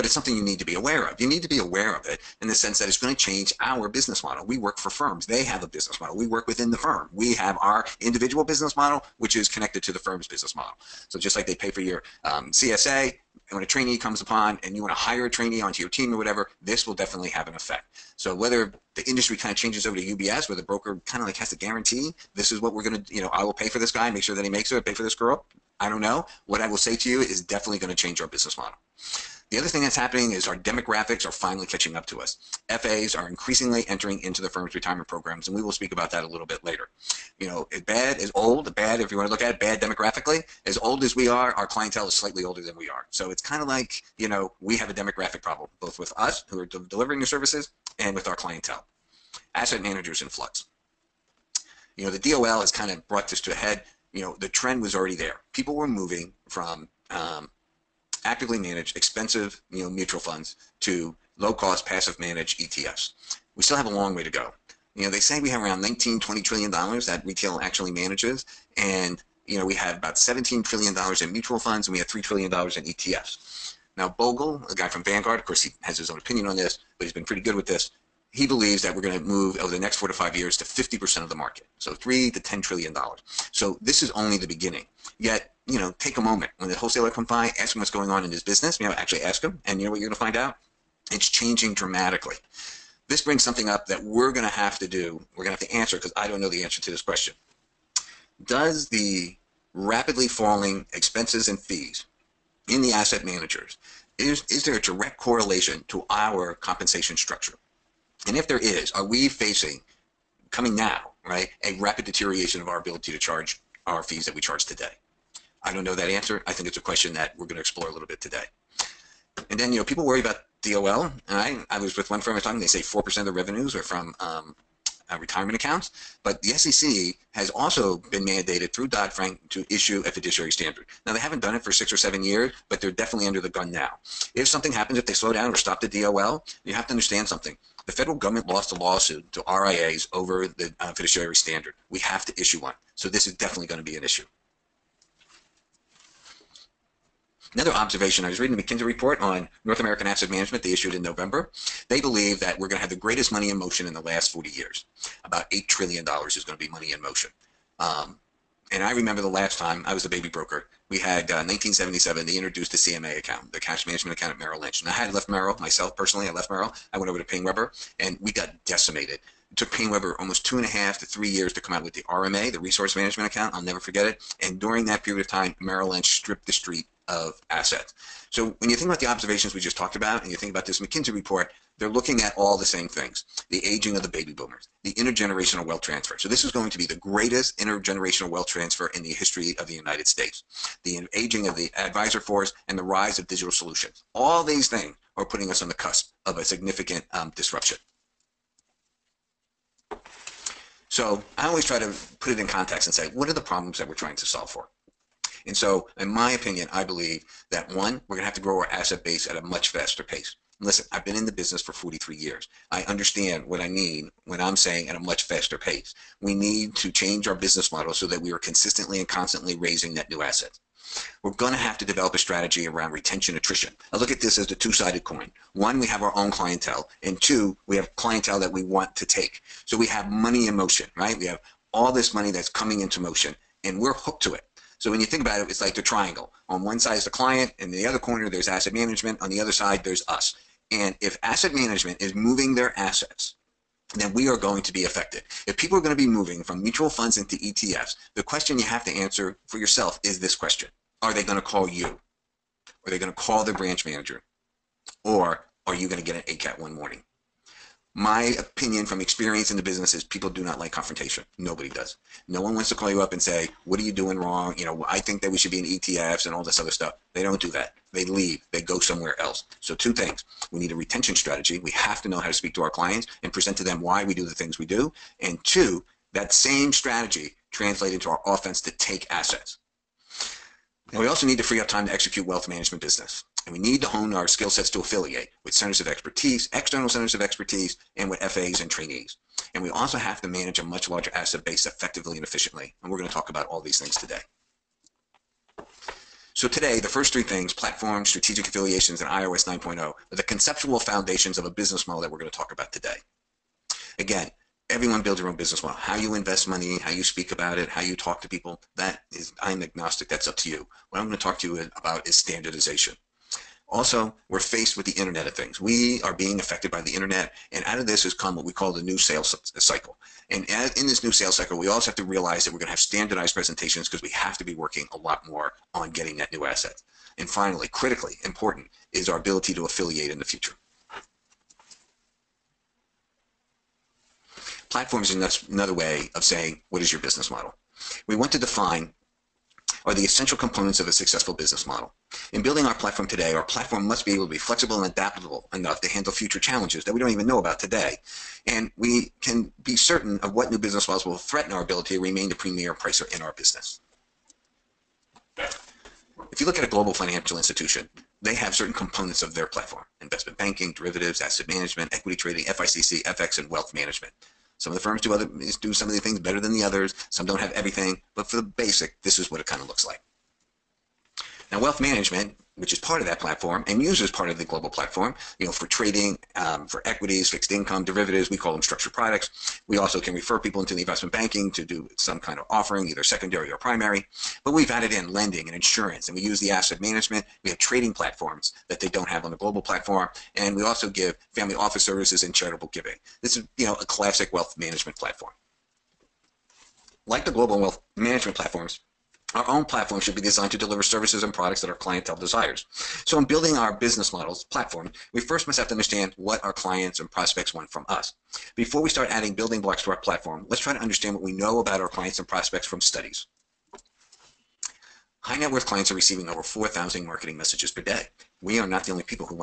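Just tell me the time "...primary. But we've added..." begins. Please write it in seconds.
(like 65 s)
383 s.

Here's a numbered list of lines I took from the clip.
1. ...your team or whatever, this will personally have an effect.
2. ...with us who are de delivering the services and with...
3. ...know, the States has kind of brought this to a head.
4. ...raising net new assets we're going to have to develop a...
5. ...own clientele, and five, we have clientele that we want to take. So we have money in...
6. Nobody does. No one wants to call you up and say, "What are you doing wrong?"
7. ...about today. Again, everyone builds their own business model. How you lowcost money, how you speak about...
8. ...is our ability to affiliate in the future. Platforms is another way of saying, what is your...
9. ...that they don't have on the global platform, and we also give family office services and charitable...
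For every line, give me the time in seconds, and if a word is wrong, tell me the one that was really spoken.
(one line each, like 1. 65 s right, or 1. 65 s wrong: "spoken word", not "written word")
1. 15 s wrong: "definitely", not "personally"
2. 45 s right
3. 52 s wrong: "DOL", not "States"
4. 219 s right
5. 226 s wrong: "two", not "five"
6. 261 s right
7. 302 s wrong: "invest", not "lowcost"
8. 328 s right
9. 388 s right.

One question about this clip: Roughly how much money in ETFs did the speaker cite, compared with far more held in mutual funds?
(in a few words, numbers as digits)
$3 trillion.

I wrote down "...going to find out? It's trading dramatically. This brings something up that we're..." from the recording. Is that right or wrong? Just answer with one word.
wrong.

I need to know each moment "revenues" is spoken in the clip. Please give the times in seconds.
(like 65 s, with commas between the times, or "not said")
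123 s.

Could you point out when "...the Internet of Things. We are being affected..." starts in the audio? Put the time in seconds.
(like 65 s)
314 s.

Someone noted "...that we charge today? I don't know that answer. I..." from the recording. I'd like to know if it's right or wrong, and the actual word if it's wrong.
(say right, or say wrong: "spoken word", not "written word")
right.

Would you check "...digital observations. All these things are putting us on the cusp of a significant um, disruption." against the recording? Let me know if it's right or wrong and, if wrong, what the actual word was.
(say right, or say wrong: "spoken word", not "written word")
wrong: "solutions", not "observations".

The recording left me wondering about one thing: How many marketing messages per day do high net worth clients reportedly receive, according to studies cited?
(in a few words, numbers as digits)
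4,000.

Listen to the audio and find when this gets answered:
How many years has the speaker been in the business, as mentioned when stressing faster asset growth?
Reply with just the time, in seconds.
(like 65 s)
211 s.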